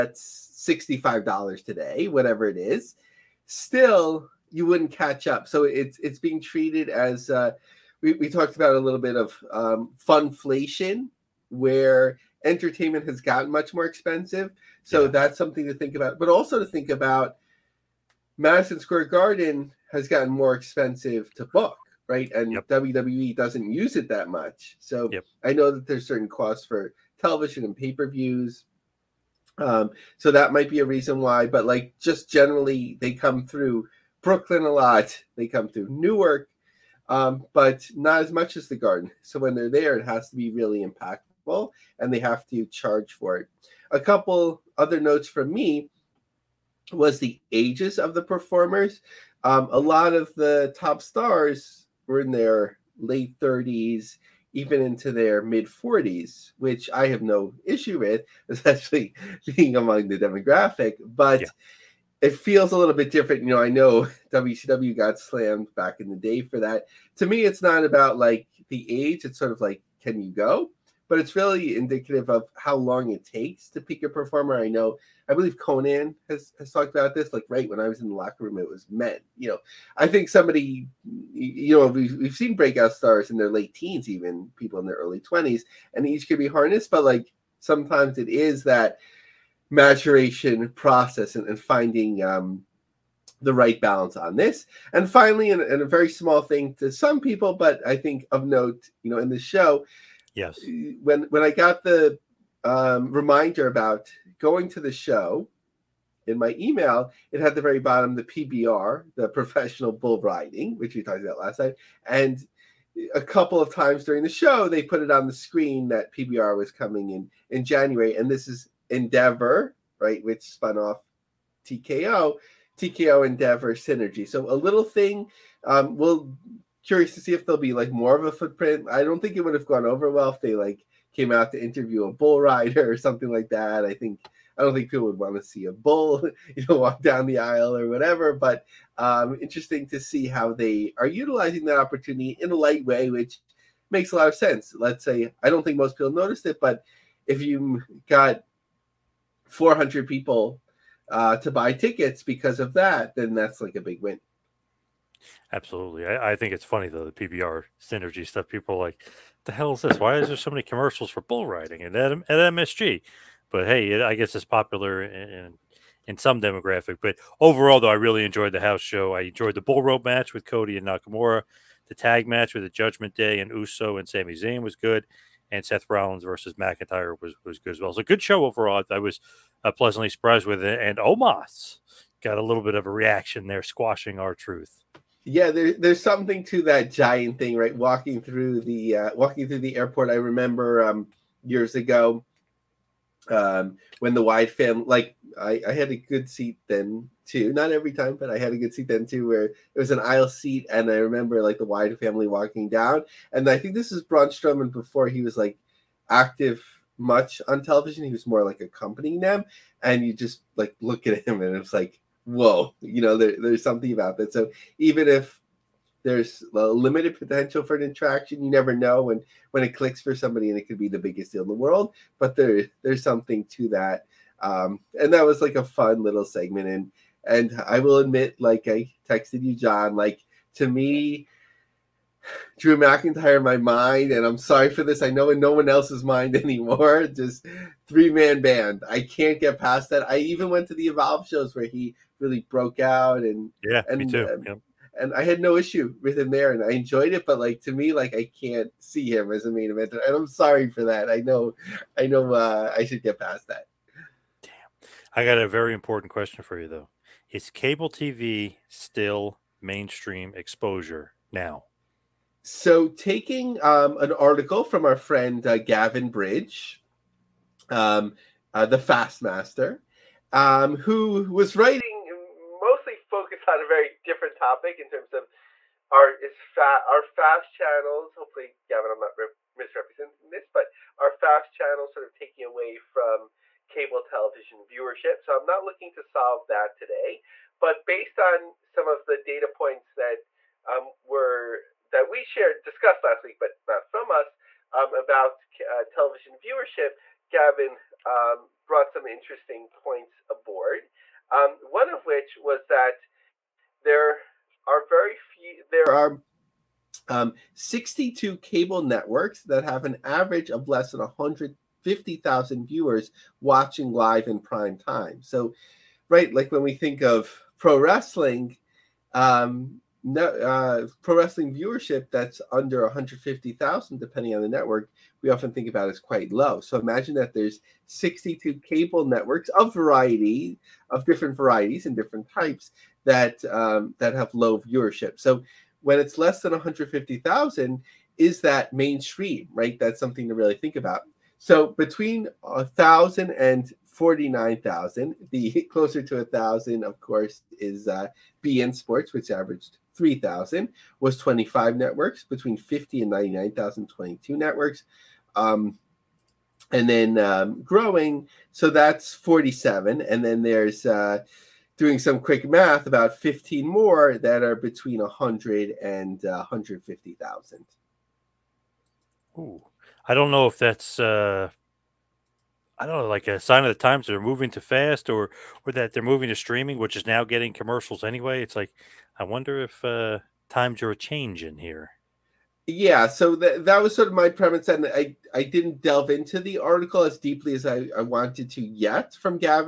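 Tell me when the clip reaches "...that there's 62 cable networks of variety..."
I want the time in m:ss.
5:27.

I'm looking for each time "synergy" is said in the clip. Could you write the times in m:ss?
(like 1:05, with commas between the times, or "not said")
2:03, 2:37.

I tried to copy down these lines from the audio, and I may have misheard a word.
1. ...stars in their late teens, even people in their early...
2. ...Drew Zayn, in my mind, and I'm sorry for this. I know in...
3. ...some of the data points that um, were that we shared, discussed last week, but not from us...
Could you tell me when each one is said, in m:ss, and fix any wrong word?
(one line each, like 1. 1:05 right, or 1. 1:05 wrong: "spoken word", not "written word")
1. 1:22 right
2. 3:52 wrong: "McIntyre", not "Zayn"
3. 4:48 right.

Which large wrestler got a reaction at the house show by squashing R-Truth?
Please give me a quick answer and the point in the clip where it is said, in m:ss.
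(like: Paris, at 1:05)
Omos, at 3:00.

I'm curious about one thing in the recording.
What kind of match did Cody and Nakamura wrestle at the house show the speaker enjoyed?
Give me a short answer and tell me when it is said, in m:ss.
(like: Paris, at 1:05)
Bull rope match, at 2:49.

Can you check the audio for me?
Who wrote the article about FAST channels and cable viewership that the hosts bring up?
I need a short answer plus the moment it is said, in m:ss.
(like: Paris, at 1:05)
Gavin Bridge, at 4:25.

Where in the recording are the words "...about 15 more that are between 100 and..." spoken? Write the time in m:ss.
6:02.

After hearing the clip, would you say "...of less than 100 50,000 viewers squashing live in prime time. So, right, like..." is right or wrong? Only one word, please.
wrong.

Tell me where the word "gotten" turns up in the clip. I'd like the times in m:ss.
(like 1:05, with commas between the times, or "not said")
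0:13, 0:20.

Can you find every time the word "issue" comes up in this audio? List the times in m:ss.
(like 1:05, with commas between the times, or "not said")
0:57, 4:05.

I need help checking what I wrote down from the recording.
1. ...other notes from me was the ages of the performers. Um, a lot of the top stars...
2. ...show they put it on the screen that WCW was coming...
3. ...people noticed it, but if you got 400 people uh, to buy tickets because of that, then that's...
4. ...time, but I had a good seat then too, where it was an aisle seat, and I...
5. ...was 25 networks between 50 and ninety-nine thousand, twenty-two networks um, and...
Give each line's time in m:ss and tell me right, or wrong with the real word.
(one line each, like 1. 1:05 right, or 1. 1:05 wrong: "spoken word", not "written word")
1. 0:44 right
2. 1:54 wrong: "PBR", not "WCW"
3. 2:25 right
4. 3:17 right
5. 5:50 right.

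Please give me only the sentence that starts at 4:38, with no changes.
Hopefully, Gavin, I'm not misrepresenting this, but our fast channels sort of taking away from cable television viewership.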